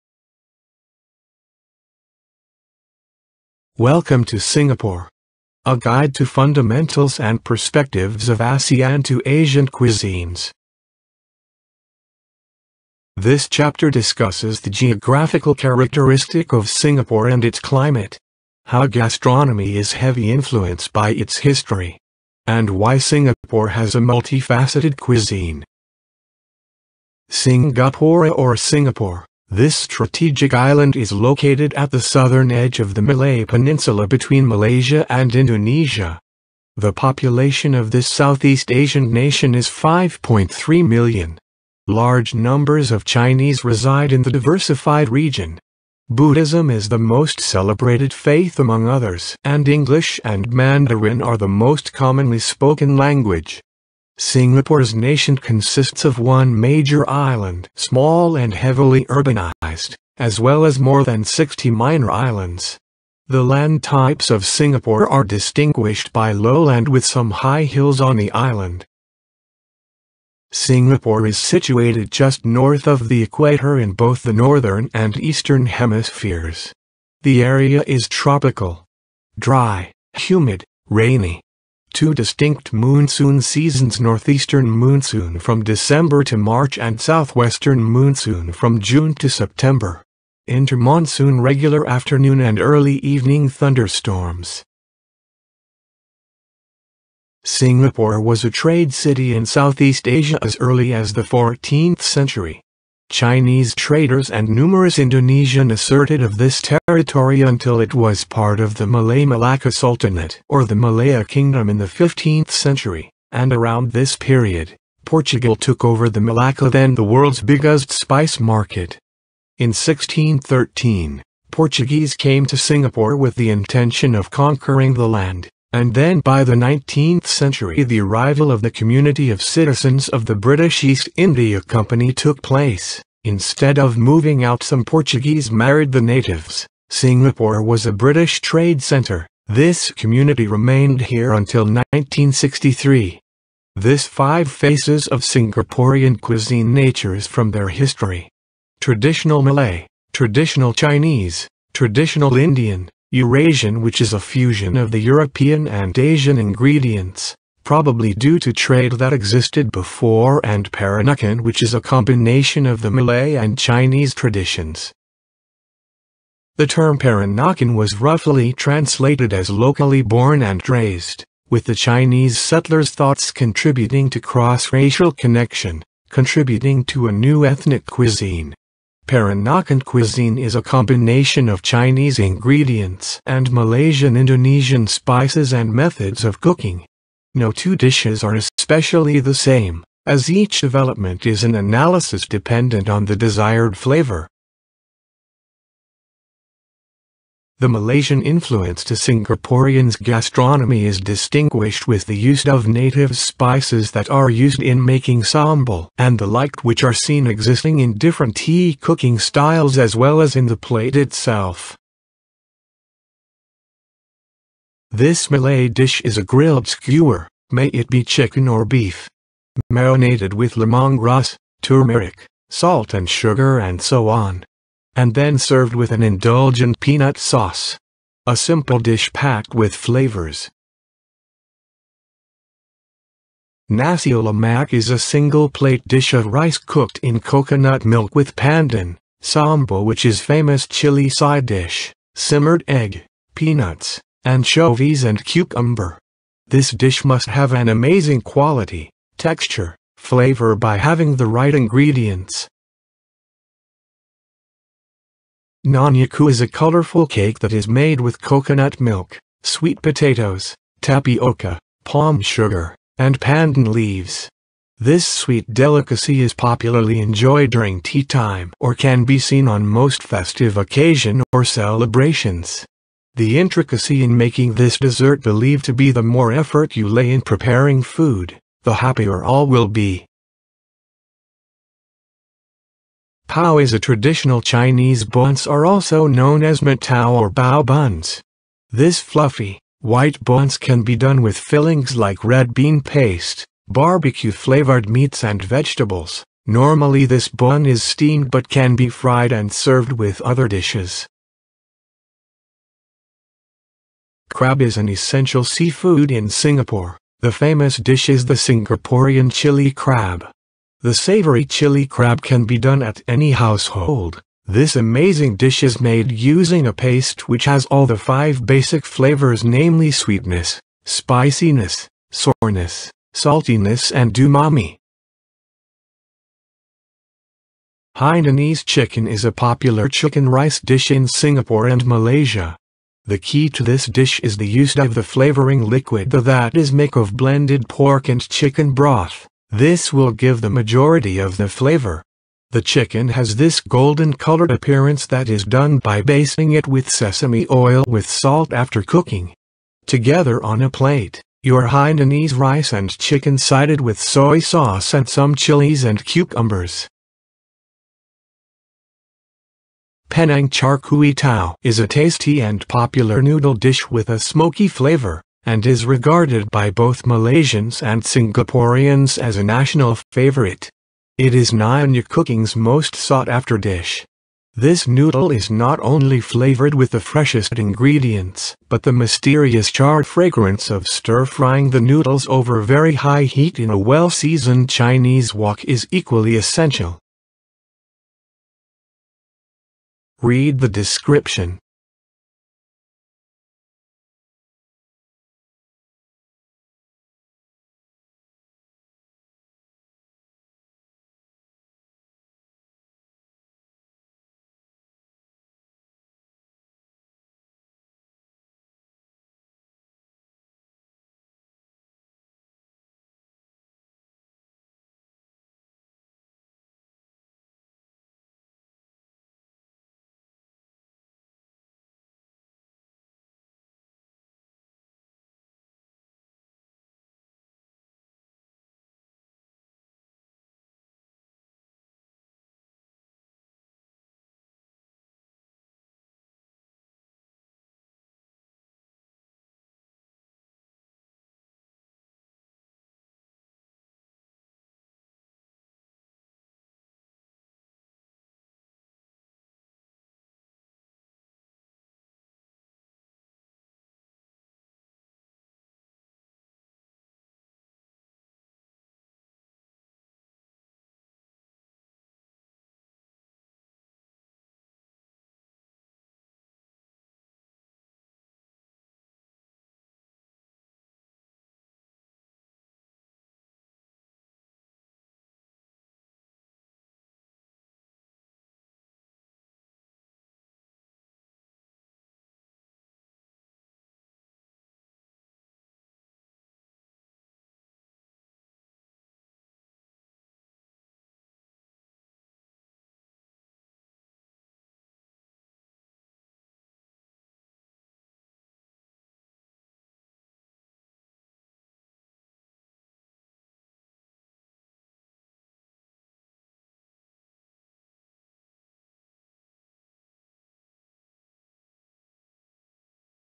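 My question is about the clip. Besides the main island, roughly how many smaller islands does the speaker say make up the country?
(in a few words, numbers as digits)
more than 60.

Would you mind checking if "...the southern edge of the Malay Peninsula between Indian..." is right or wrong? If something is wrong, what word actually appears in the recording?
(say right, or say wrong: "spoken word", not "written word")
wrong: "Malaysia", not "Indian".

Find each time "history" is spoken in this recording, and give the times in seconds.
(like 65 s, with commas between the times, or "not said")
21 s, 147 s.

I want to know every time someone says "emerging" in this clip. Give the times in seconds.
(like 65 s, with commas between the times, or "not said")
not said.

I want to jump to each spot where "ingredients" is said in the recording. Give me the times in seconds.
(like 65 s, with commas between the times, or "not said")
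156 s, 182 s, 251 s, 377 s.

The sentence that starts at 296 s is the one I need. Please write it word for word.
Normally this bun is steamed but can be fried and served with other dishes.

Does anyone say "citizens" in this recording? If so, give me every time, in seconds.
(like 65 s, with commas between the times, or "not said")
129 s.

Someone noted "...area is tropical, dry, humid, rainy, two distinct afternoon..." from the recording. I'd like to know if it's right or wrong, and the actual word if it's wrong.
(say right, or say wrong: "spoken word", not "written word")
wrong: "monsoon", not "afternoon".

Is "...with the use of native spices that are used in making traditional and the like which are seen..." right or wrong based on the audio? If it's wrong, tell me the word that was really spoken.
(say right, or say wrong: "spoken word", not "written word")
wrong: "sambal", not "traditional".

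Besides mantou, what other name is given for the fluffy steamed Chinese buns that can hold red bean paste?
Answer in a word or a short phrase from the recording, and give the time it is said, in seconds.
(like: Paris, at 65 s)
bao buns, at 287 s.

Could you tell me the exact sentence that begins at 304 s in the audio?
Crab is an essential seafood in Singapore.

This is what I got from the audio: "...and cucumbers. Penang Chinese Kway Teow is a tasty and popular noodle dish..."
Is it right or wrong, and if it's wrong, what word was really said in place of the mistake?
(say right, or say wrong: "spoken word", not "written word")
wrong: "Char", not "Chinese".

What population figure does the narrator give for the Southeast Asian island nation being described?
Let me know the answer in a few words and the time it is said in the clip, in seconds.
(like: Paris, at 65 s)
5.3 million, at 39 s.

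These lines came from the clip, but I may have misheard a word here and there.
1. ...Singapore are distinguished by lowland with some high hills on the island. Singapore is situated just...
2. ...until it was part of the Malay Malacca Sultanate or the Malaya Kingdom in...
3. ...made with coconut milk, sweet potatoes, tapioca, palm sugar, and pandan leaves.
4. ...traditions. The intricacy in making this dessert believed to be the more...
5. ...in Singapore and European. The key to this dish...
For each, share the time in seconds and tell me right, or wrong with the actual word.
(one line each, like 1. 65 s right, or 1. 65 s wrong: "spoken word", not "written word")
1. 64 s right
2. 107 s right
3. 257 s right
4. 271 s wrong: "celebrations", not "traditions"
5. 330 s wrong: "Malaysia", not "European".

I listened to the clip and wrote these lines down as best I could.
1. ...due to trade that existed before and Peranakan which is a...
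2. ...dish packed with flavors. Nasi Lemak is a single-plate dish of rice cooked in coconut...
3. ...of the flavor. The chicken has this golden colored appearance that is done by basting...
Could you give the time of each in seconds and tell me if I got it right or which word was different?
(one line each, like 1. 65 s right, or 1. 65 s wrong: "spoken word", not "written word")
1. 158 s right
2. 228 s right
3. 341 s right.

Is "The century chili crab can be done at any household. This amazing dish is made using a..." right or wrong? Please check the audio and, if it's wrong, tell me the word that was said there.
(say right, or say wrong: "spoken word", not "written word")
wrong: "savory", not "century".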